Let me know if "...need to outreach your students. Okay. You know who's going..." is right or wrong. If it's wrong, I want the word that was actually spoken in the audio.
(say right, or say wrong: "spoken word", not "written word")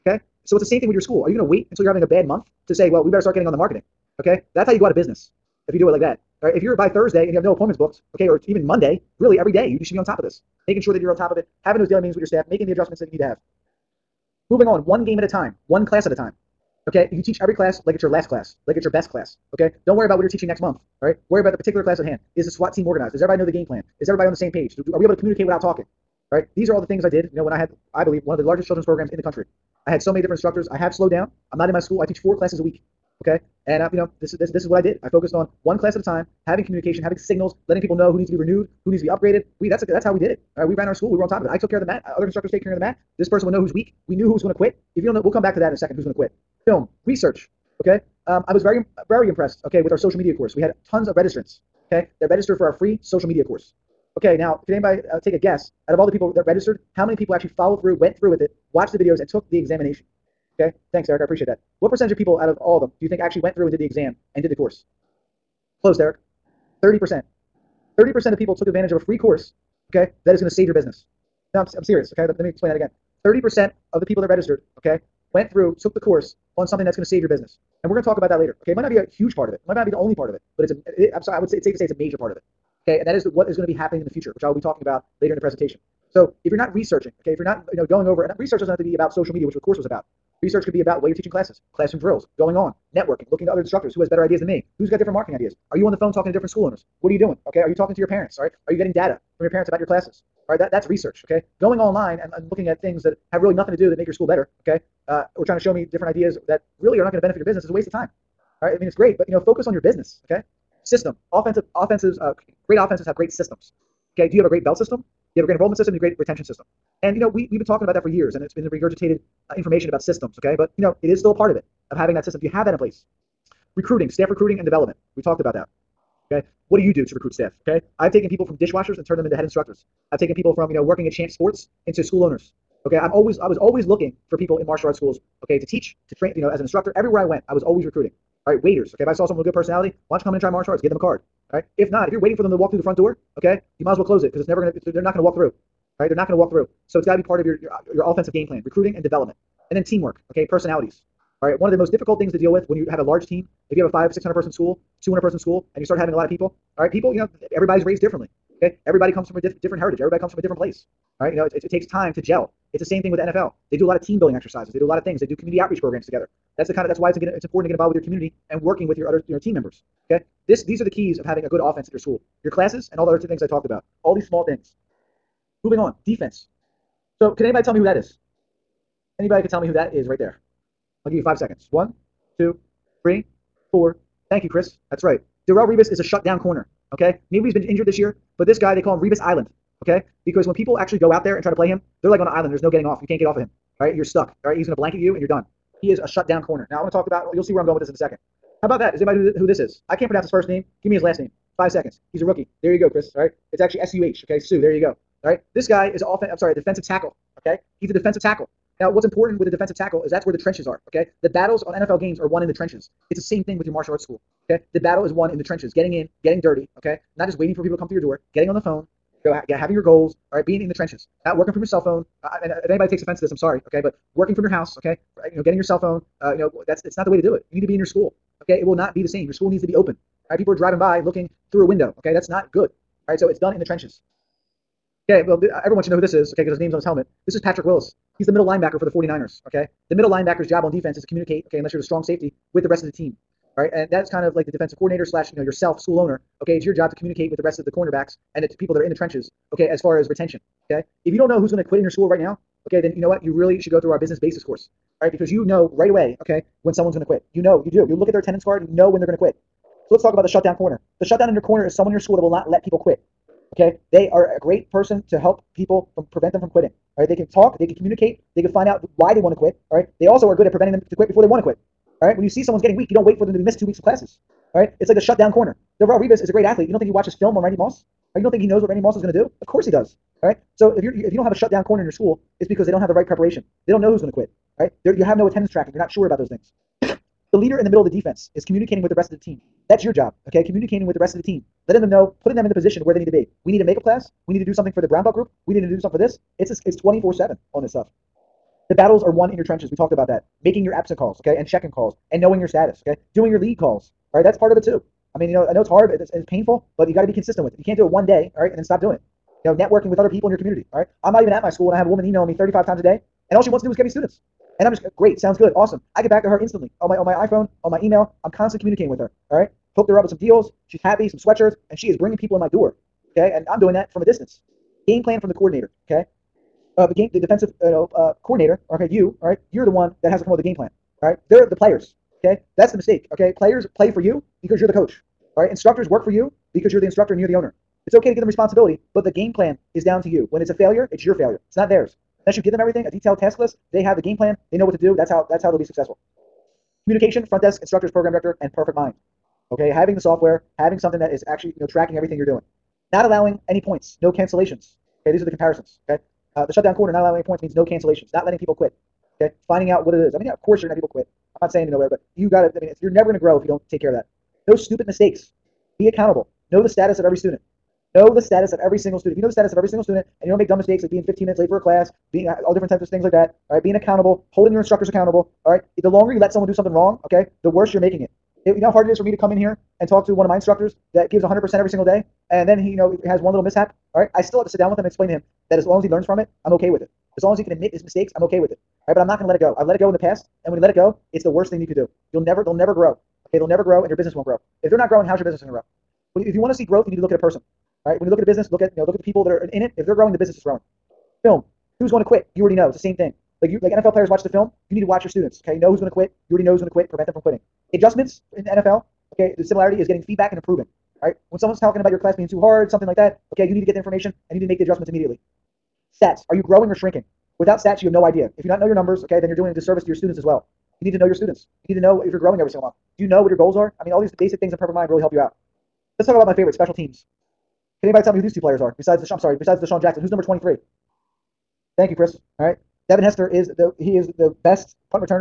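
wrong: "watch", not "outreach".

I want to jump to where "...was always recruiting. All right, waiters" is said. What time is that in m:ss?
2:17.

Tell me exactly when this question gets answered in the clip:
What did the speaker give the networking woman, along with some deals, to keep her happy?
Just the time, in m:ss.
5:21.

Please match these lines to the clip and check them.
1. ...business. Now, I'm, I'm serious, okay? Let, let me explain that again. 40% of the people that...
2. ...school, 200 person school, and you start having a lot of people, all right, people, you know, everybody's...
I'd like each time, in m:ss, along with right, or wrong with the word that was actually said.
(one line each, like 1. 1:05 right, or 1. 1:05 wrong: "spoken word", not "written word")
1. 1:10 wrong: "30", not "40"
2. 2:34 right.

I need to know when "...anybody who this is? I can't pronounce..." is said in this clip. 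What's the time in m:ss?
3:19.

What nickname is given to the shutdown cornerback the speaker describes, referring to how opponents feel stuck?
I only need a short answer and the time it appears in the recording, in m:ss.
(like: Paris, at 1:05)
Revis Island, at 3:08.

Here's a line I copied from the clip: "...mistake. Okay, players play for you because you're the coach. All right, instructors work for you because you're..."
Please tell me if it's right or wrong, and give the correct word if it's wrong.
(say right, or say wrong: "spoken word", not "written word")
right.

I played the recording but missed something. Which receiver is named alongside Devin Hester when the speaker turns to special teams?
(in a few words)
DeSean Jackson.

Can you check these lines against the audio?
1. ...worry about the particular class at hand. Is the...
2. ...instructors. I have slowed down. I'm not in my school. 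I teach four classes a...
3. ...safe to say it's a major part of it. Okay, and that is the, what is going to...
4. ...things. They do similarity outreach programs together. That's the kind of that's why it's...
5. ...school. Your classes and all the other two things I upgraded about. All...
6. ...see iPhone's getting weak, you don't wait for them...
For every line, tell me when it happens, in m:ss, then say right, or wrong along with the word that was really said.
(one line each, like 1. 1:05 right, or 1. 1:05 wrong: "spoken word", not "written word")
1. 0:21 right
2. 0:30 right
3. 1:21 right
4. 2:45 wrong: "community", not "similarity"
5. 2:51 wrong: "talked", not "upgraded"
6. 4:32 wrong: "someone", not "iPhone".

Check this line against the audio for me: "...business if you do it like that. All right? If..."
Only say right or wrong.
right.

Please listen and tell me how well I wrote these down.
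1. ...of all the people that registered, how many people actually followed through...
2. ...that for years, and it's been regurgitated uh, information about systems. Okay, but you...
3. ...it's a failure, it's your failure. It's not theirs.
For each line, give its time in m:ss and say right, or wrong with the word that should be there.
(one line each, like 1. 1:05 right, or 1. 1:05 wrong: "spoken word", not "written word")
1. 0:55 right
2. 1:57 right
3. 5:40 right.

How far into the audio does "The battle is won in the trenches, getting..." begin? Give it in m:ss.
3:34.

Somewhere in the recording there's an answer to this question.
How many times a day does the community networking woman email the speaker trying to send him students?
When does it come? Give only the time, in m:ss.
5:12.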